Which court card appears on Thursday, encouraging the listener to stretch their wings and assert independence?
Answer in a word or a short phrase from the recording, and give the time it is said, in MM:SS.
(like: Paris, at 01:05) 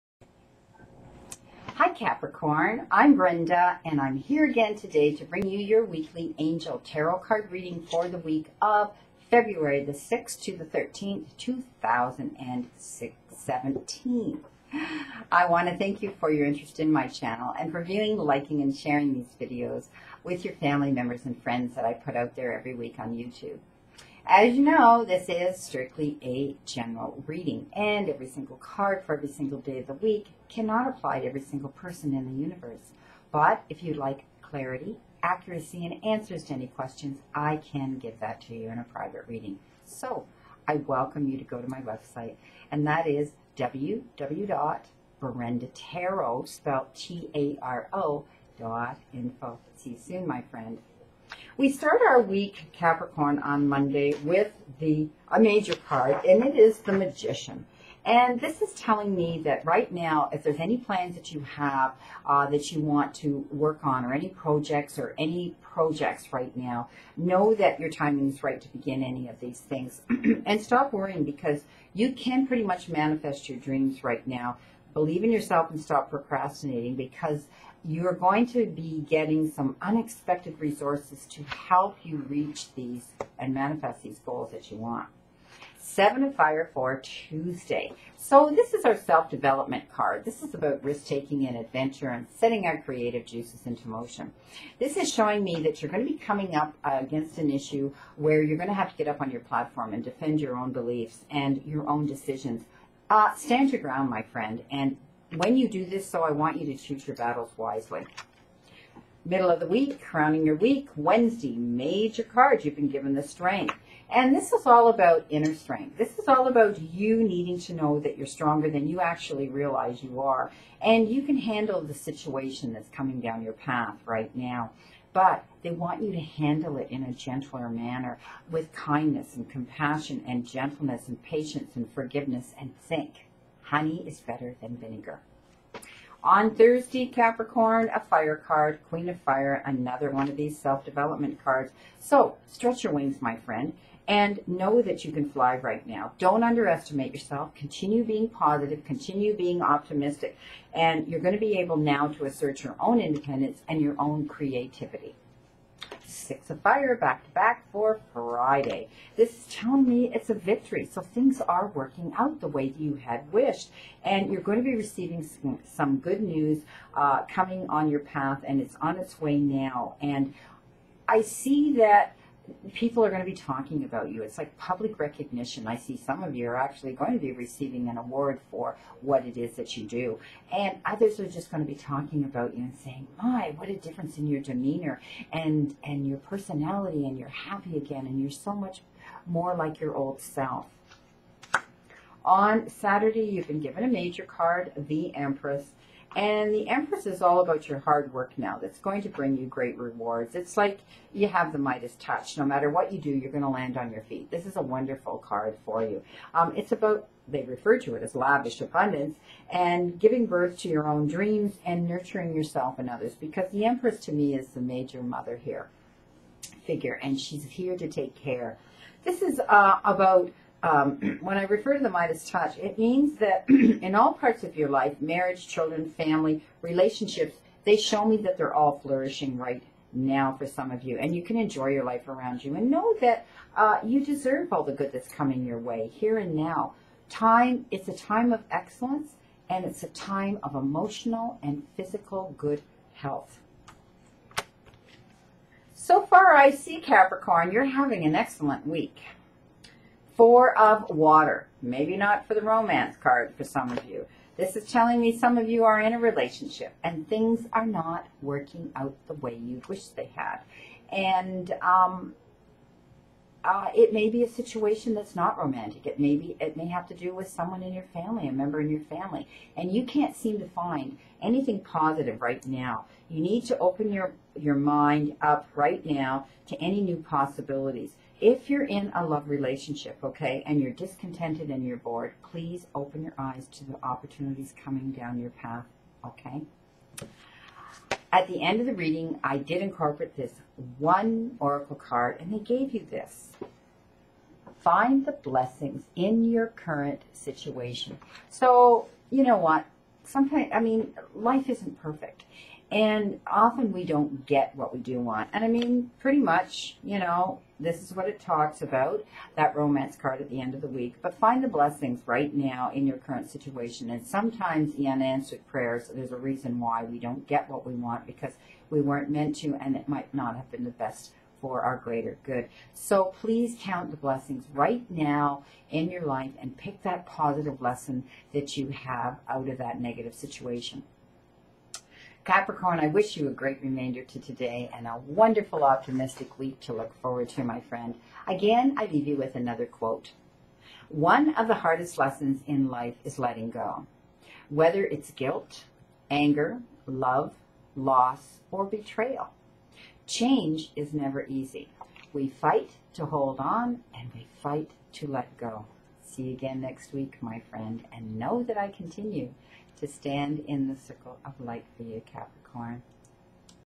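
Queen of Fire, at 02:18.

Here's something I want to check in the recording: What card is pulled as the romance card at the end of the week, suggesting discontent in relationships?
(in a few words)
Four of Water.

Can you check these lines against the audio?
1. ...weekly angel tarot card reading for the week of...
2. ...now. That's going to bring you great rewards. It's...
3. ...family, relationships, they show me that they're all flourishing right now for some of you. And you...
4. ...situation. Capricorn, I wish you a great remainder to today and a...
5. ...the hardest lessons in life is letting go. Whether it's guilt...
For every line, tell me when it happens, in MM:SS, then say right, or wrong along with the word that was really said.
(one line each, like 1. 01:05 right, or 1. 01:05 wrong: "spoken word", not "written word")
1. 00:05 right
2. 03:18 right
3. 03:45 right
4. 05:30 right
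5. 05:41 right.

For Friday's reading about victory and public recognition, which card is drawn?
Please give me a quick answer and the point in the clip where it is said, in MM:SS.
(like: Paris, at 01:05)
Six of Fire, at 02:36.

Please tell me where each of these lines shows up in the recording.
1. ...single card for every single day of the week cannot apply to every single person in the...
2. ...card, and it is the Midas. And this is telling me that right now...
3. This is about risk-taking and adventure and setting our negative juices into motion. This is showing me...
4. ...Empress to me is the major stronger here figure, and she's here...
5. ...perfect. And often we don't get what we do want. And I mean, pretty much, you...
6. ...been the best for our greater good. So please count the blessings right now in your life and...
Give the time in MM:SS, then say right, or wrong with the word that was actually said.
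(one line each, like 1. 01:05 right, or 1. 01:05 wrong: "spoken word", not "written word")
1. 00:28 right
2. 00:55 wrong: "Magician", not "Midas"
3. 01:30 wrong: "creative", not "negative"
4. 03:33 wrong: "mother", not "stronger"
5. 05:01 right
6. 05:20 right.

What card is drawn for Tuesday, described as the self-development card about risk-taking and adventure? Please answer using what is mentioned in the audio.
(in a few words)
Seven of Fire.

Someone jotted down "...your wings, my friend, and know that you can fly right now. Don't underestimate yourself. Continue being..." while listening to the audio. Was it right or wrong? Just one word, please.
right.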